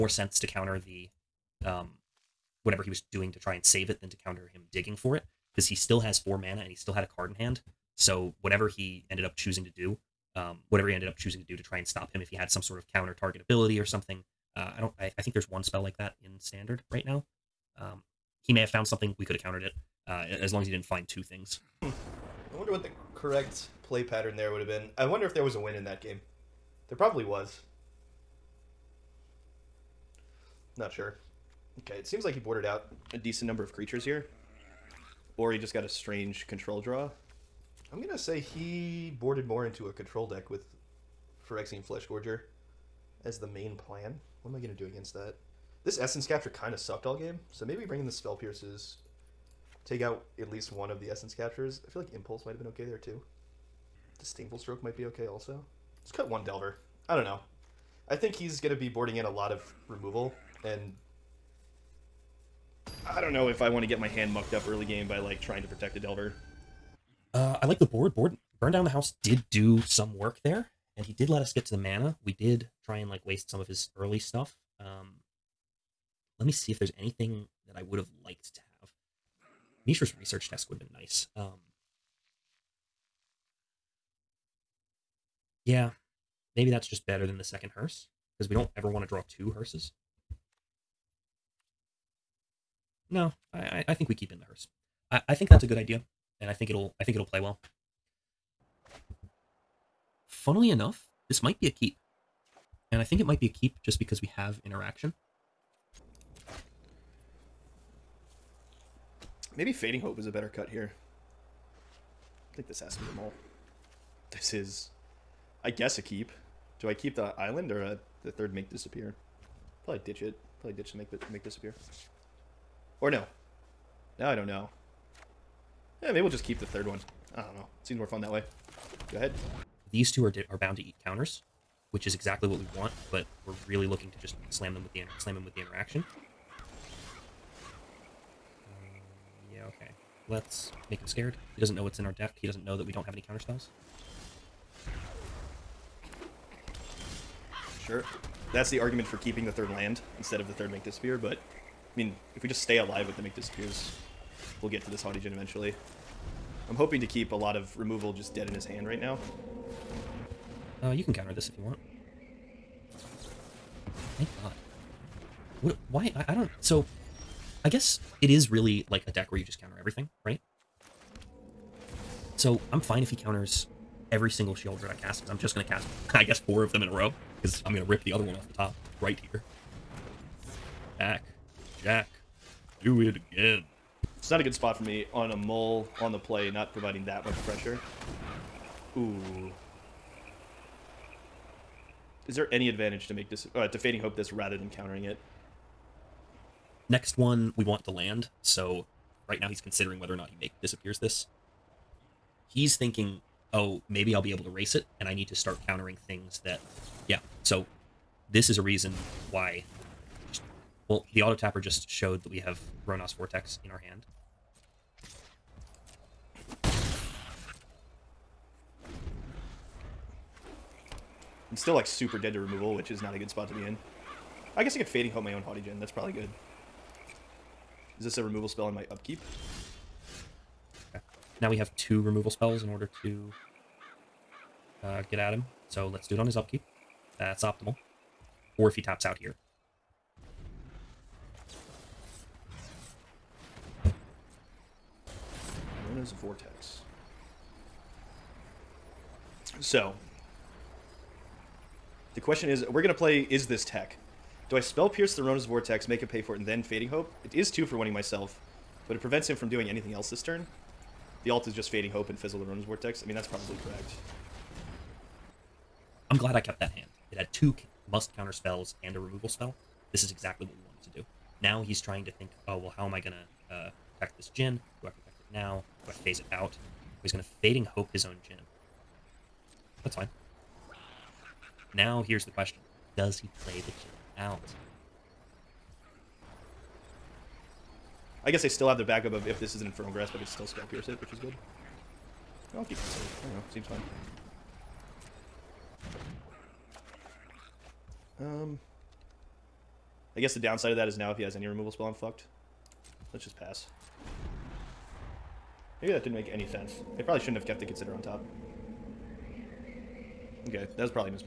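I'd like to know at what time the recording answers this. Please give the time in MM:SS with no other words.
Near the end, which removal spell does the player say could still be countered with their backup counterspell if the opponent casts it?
04:49.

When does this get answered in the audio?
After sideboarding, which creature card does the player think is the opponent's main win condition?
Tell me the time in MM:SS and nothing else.
00:41.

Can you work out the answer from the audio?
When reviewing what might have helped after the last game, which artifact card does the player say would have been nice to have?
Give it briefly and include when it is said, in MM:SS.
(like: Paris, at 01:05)
Mishra's Research Desk, at 01:19.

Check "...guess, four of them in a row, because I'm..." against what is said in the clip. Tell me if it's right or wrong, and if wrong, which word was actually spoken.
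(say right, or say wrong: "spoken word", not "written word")
right.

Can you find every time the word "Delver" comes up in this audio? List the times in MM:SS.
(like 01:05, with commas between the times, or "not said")
00:56, 01:05.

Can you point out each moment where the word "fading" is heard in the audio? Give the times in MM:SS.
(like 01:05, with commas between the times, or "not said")
01:49, 03:13, 03:44, 04:16, 04:21, 04:37.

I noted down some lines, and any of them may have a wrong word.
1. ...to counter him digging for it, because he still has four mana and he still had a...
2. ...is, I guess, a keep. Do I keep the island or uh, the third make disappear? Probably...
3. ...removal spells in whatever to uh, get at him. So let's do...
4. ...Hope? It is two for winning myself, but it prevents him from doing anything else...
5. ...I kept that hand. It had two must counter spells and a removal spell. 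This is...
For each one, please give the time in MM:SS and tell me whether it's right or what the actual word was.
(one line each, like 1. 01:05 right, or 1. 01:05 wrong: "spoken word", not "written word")
1. 00:04 right
2. 01:54 right
3. 03:52 wrong: "order", not "whatever"
4. 04:16 right
5. 04:26 right.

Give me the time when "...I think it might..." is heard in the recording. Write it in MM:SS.
01:42.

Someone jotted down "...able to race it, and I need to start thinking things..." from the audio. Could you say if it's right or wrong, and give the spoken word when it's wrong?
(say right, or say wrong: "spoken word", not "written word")
wrong: "countering", not "thinking".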